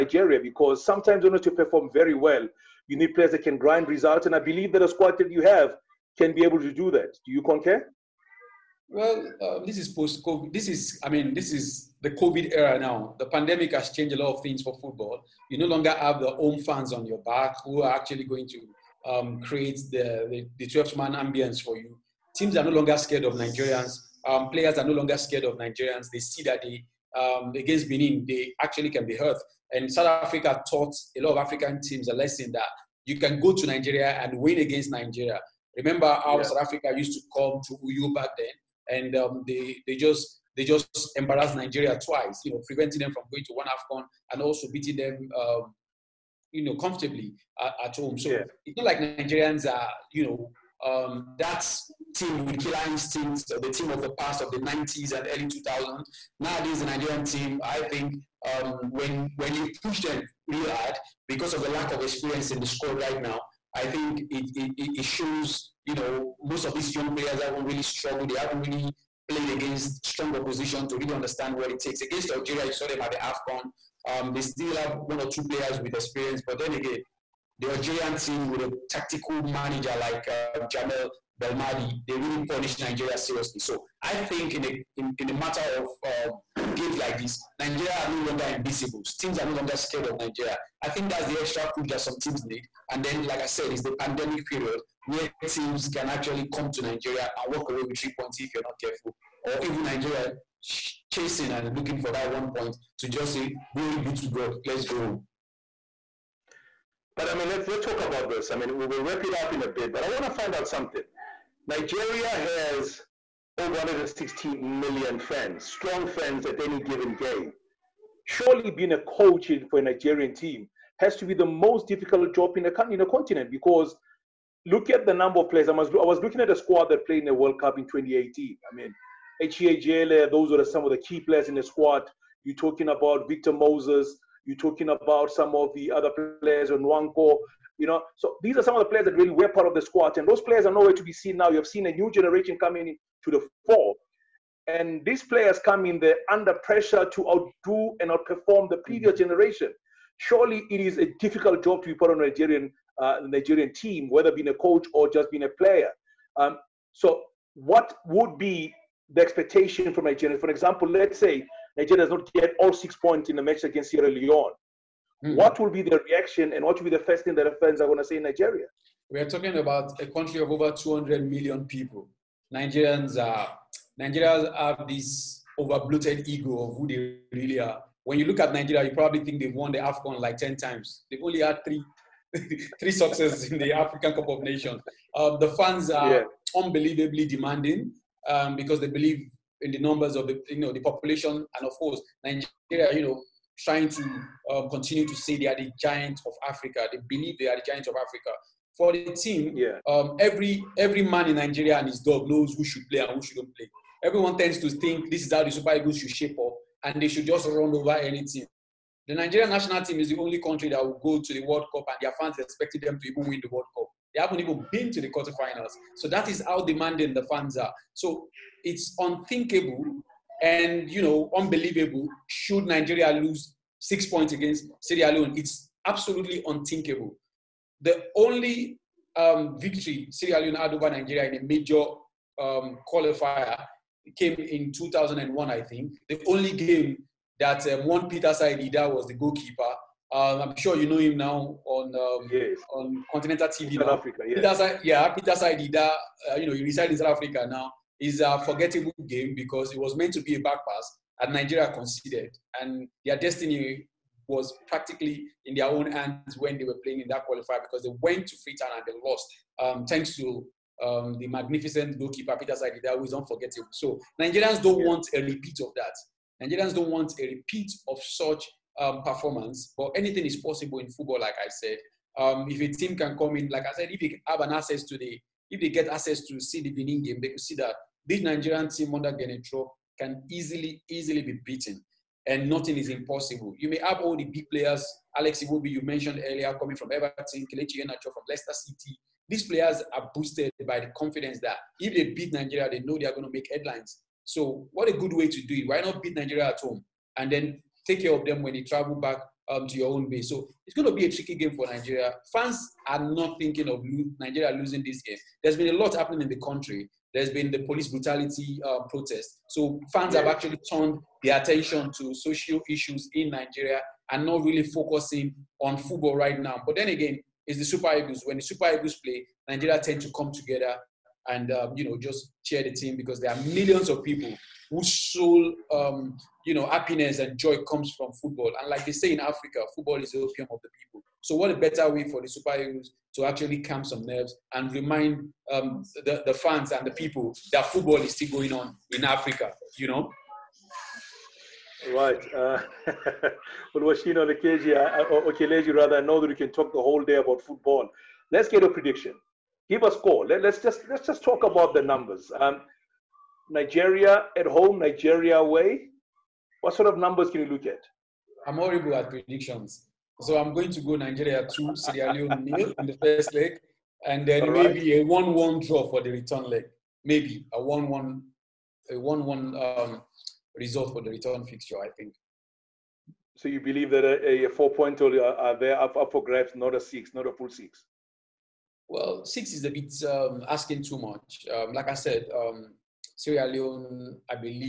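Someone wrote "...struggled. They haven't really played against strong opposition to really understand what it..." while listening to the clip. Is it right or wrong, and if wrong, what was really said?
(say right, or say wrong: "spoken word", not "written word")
right.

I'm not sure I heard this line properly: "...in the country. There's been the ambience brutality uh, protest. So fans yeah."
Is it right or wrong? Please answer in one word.
wrong.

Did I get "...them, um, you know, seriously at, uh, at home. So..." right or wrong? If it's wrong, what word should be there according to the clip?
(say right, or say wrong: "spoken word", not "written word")
wrong: "comfortably", not "seriously".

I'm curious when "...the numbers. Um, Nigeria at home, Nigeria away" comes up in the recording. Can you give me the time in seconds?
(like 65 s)
351 s.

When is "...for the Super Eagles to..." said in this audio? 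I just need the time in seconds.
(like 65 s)
332 s.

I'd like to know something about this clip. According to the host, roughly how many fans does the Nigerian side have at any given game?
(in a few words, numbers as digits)
116 million.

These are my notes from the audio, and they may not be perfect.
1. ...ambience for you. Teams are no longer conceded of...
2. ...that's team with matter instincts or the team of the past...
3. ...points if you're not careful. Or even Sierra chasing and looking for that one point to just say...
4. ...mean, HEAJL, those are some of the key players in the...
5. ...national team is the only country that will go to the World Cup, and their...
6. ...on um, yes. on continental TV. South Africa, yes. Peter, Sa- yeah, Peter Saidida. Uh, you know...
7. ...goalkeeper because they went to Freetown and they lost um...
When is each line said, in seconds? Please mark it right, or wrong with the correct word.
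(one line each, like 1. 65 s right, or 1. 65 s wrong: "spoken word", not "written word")
1. 21 s wrong: "scared", not "conceded"
2. 51 s wrong: "killer", not "matter"
3. 98 s wrong: "Nigeria", not "Sierra"
4. 128 s right
5. 209 s right
6. 241 s right
7. 257 s wrong: "qualifier", not "goalkeeper".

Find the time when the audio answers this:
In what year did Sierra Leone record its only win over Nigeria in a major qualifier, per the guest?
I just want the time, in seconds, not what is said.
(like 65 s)
234 s.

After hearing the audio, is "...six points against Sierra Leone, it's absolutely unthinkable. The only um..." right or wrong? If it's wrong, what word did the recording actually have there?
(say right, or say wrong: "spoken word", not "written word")
right.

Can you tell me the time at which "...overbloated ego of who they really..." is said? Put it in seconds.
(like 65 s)
175 s.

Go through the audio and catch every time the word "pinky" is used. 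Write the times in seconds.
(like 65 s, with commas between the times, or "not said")
not said.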